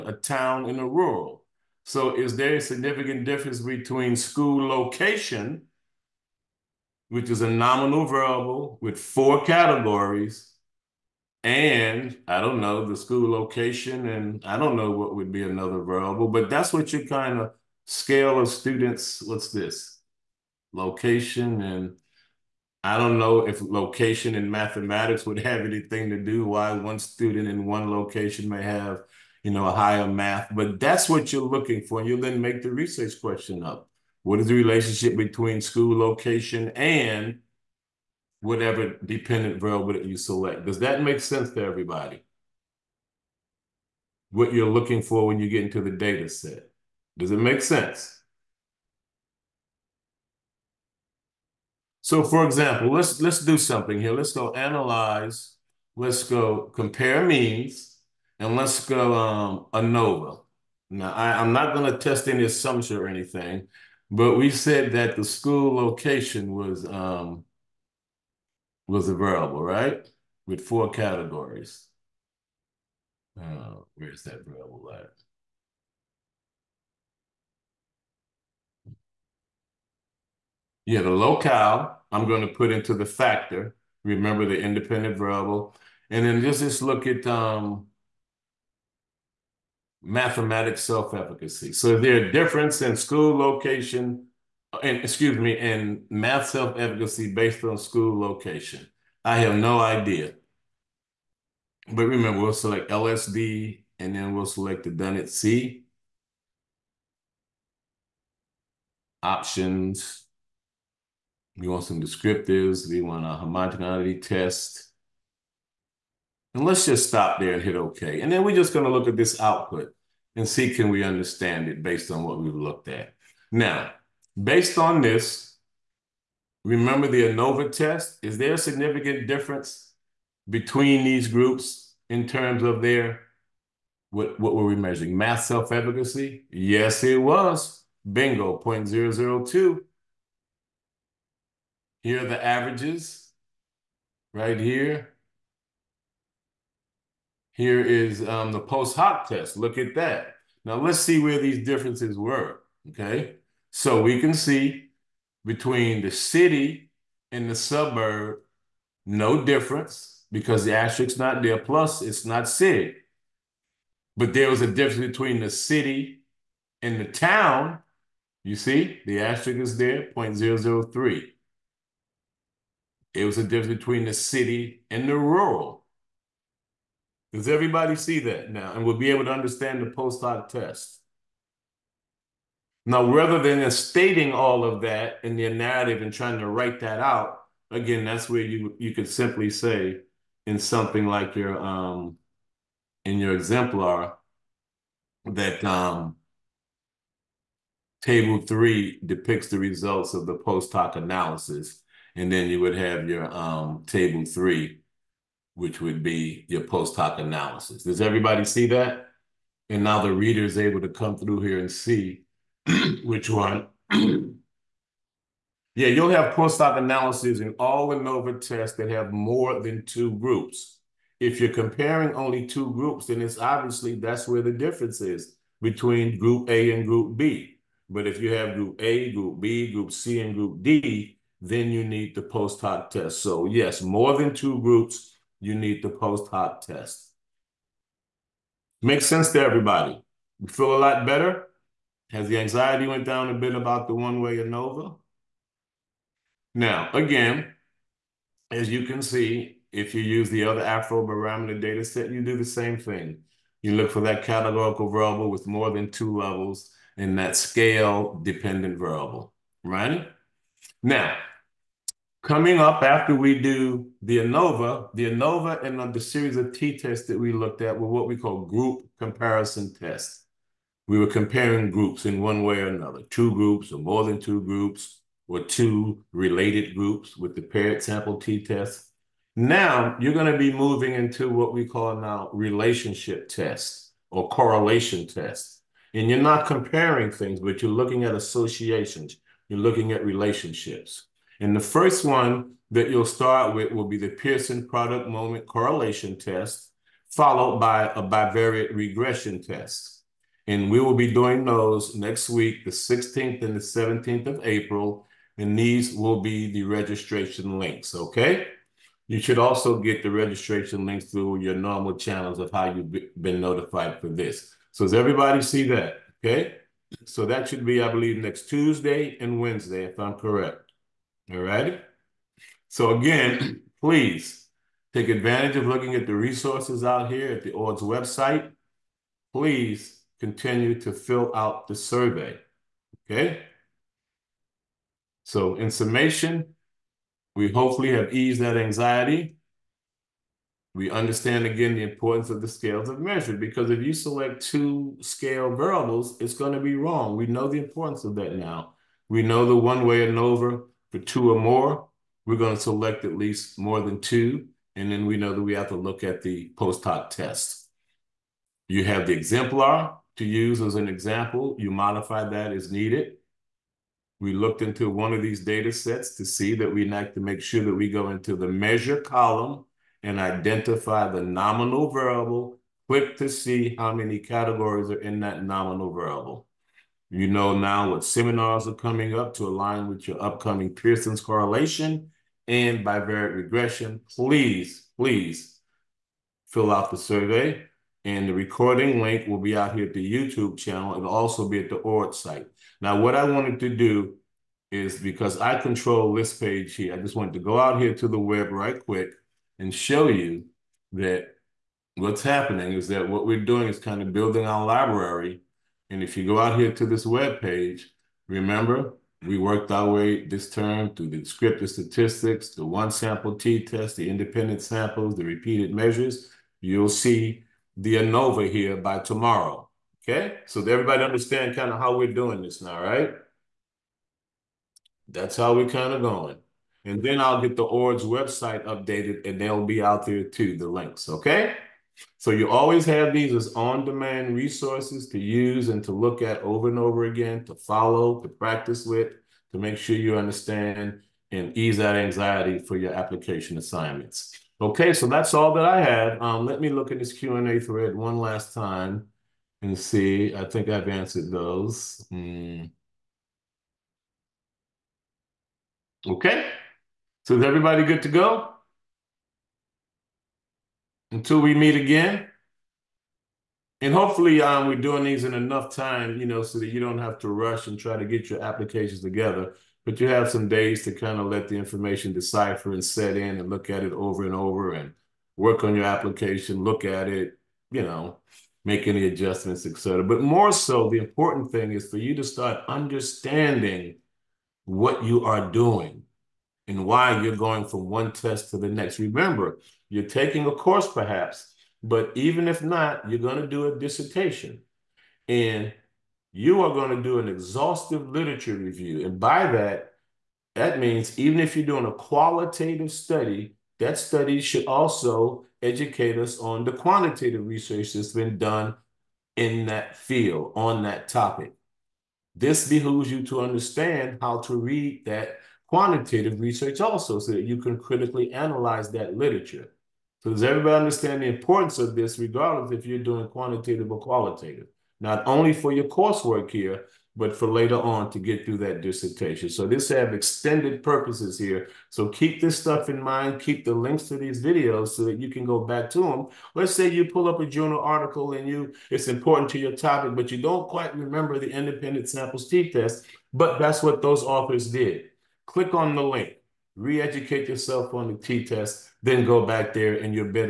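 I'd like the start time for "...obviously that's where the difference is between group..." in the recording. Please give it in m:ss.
3:43.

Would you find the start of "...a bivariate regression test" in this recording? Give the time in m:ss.
4:57.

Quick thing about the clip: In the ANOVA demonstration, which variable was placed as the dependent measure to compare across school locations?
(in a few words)
Mathematics self-efficacy.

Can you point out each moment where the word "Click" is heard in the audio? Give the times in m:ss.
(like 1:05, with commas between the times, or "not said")
6:12, 9:05.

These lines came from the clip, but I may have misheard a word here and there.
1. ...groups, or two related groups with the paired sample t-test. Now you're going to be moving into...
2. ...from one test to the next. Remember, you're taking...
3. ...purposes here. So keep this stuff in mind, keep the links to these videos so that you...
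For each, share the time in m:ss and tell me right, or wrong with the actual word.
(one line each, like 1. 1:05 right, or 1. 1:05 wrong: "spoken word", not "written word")
1. 4:34 right
2. 8:07 right
3. 8:50 right.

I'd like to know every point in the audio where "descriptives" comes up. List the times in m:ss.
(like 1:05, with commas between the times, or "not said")
1:52, 6:51.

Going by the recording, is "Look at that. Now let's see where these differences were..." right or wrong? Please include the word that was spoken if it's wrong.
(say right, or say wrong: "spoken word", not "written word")
right.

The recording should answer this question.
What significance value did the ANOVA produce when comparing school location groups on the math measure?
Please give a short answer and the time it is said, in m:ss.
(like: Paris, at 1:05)
0.002, at 2:18.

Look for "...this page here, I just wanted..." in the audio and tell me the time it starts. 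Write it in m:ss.
6:36.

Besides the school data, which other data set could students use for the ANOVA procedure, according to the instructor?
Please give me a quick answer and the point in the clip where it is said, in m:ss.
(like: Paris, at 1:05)
Afrobarometer, at 4:10.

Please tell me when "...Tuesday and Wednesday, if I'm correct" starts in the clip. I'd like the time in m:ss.
5:18.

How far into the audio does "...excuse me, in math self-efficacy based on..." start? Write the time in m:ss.
1:34.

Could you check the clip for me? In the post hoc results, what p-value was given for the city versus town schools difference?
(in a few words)
0.003.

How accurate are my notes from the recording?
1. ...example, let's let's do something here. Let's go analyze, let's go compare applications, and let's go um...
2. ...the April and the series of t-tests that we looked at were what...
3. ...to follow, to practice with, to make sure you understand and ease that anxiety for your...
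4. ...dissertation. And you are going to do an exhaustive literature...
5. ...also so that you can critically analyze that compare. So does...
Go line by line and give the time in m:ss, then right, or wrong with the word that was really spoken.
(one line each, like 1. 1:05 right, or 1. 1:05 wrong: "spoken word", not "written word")
1. 0:52 wrong: "means", not "applications"
2. 4:24 wrong: "ANOVA", not "April"
3. 7:17 right
4. 8:13 right
5. 8:36 wrong: "literature", not "compare".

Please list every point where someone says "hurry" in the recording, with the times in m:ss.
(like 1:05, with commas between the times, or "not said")
not said.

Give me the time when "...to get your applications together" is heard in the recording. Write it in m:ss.
7:47.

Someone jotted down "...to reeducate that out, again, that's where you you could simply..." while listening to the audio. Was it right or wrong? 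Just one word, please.
wrong.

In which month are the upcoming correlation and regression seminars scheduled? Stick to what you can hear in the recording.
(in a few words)
April.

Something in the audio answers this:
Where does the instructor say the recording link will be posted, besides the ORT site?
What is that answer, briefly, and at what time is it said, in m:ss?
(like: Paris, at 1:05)
YouTube channel, at 6:30.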